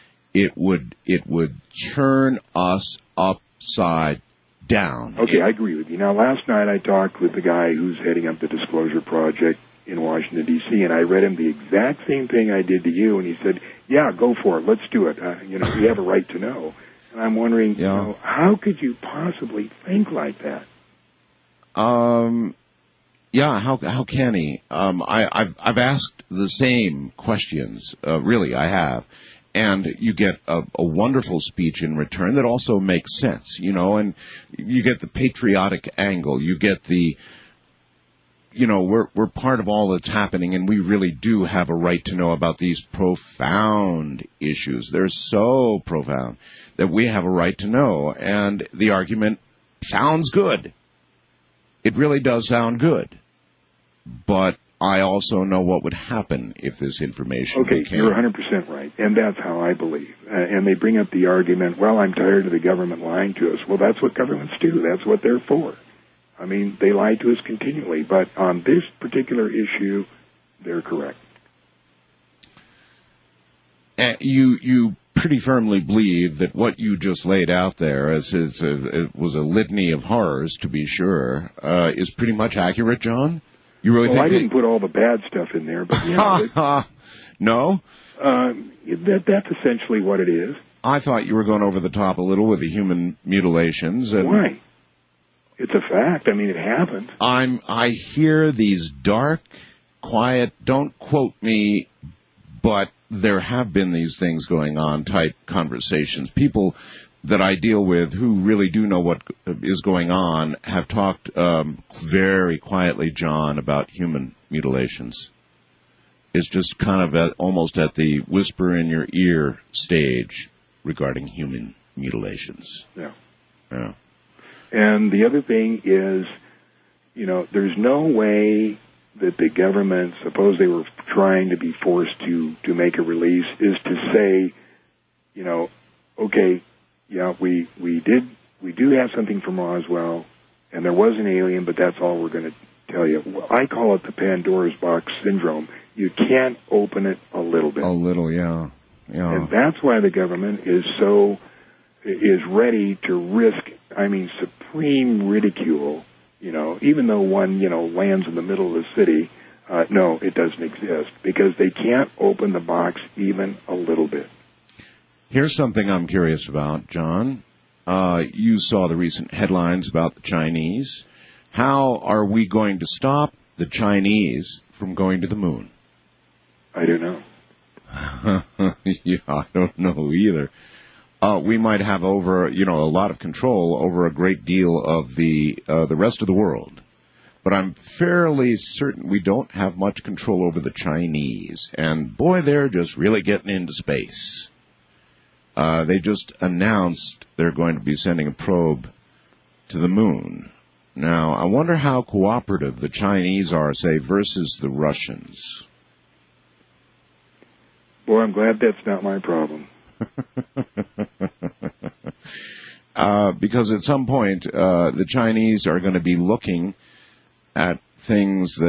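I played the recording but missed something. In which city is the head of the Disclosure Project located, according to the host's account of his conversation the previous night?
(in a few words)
Washington D.C.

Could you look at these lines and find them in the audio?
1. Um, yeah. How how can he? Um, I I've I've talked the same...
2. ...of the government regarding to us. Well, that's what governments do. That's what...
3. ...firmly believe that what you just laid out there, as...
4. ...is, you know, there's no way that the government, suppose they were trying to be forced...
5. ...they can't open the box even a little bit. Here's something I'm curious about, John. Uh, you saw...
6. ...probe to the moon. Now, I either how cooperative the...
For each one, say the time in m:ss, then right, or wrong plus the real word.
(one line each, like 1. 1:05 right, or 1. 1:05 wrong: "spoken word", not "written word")
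1. 0:21 wrong: "asked", not "talked"
2. 1:02 wrong: "lying", not "regarding"
3. 1:15 right
4. 2:05 right
5. 2:41 right
6. 3:18 wrong: "wonder", not "either".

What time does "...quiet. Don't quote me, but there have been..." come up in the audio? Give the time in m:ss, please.
1:40.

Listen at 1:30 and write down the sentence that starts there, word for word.
I thought you were going over the top a little with the human mutilations.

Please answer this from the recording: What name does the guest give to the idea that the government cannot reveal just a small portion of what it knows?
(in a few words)
Pandora's box syndrome.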